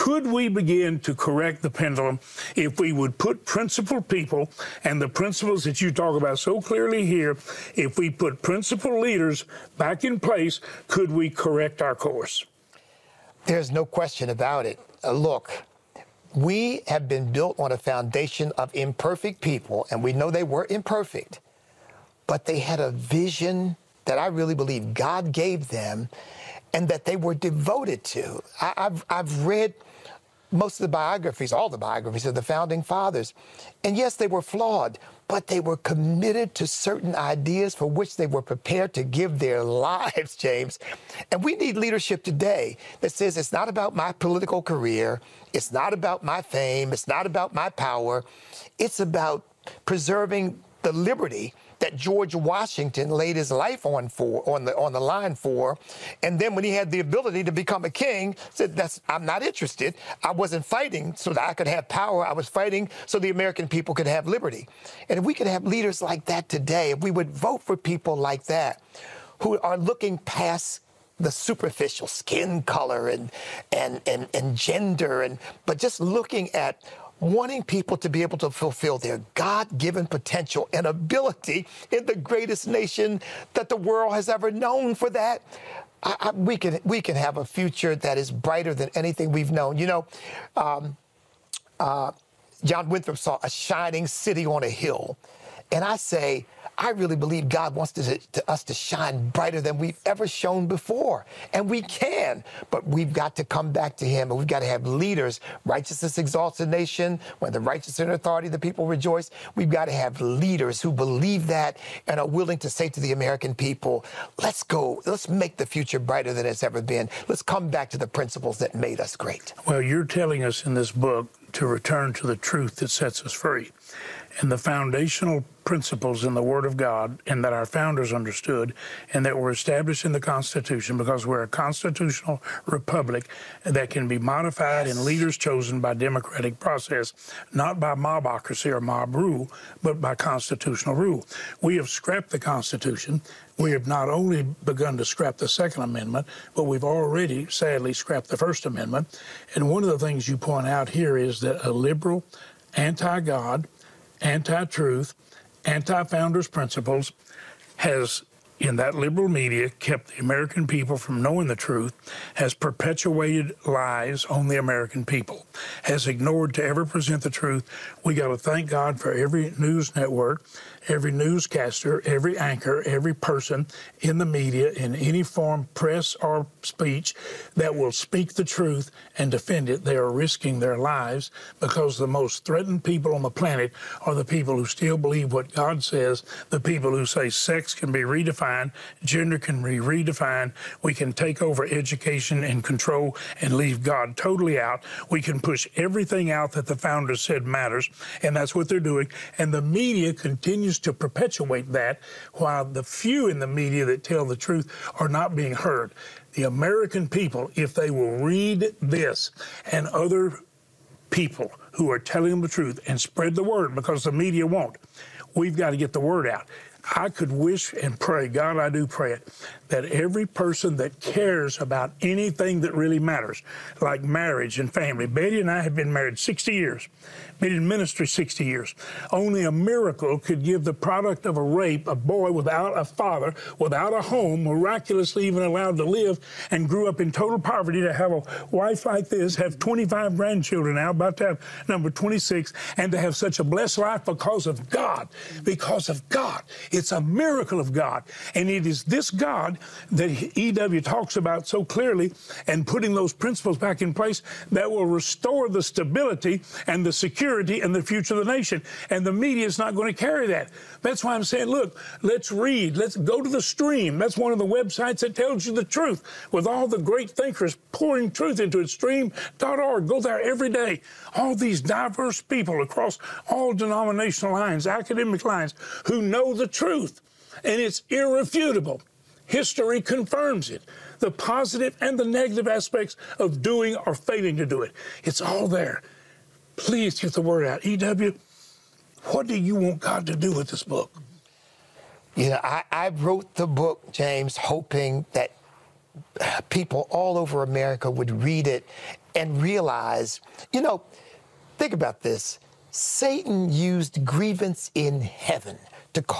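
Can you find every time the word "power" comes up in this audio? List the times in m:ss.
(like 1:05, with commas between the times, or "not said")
0:47, 1:01.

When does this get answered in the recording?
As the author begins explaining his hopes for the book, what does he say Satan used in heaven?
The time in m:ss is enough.
5:04.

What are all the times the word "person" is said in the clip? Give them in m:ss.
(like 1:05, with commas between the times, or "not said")
2:53, 3:40.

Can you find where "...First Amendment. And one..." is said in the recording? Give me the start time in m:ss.
2:28.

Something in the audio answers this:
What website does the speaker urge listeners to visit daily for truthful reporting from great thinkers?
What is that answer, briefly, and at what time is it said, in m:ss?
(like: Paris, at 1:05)
Stream.org, at 4:28.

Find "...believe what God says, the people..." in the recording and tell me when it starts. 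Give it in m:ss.
3:04.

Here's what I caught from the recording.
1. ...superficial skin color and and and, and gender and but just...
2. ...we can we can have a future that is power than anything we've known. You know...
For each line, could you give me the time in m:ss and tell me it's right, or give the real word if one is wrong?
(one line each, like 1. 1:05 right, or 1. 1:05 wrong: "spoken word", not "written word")
1. 1:11 right
2. 1:26 wrong: "brighter", not "power".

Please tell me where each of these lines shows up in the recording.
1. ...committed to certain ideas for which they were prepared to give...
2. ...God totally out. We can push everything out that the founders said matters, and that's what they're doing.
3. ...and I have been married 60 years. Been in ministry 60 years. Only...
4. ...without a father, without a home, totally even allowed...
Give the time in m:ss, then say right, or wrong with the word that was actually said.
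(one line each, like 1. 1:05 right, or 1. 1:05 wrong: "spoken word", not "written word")
1. 0:35 right
2. 3:13 right
3. 3:45 right
4. 3:52 wrong: "miraculously", not "totally".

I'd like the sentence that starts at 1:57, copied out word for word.
Let's come back to the principles that made us great.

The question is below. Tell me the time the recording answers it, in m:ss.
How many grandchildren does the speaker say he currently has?
3:59.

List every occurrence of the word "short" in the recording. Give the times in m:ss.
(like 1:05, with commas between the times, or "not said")
not said.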